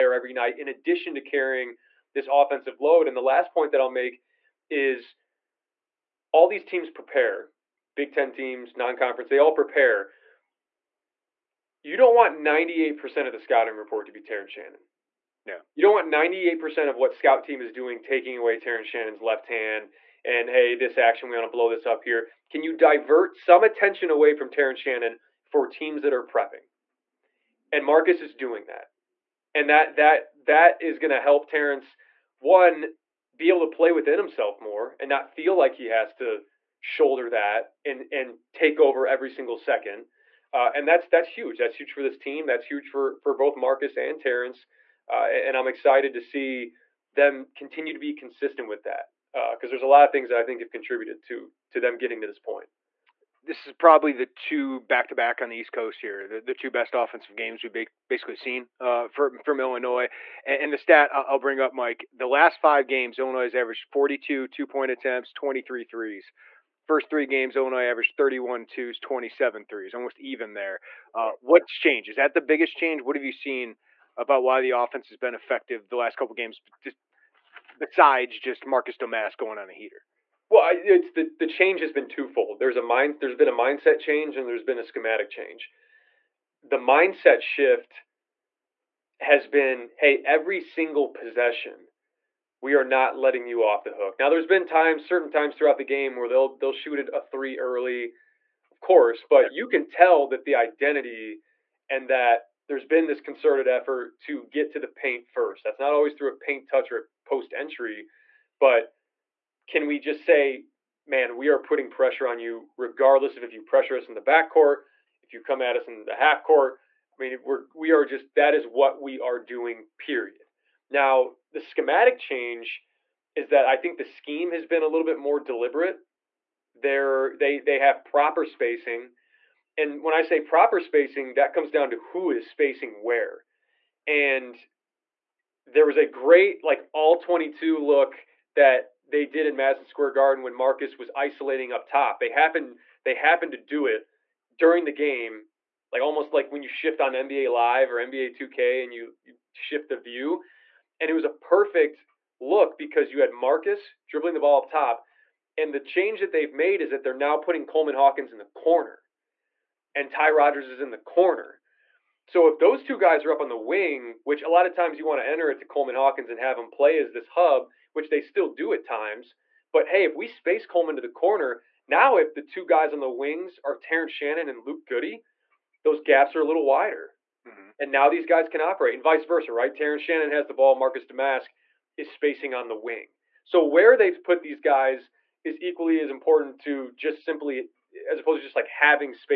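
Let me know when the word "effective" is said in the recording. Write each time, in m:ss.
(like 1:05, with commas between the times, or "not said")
1:15.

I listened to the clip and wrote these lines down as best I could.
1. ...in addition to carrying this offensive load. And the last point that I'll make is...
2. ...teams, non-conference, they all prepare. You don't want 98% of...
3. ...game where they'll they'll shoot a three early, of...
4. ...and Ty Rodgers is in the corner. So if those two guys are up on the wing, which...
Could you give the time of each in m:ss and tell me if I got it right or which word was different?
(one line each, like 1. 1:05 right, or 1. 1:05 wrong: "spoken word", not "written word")
1. 0:00 right
2. 0:08 right
3. 1:35 right
4. 2:39 right.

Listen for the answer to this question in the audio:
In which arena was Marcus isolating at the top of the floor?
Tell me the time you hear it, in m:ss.
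2:19.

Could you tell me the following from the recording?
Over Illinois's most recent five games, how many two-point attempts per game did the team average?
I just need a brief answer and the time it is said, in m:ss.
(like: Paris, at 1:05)
42, at 1:03.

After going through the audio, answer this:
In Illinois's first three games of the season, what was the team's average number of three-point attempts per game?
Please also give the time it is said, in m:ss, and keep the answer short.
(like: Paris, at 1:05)
27, at 1:08.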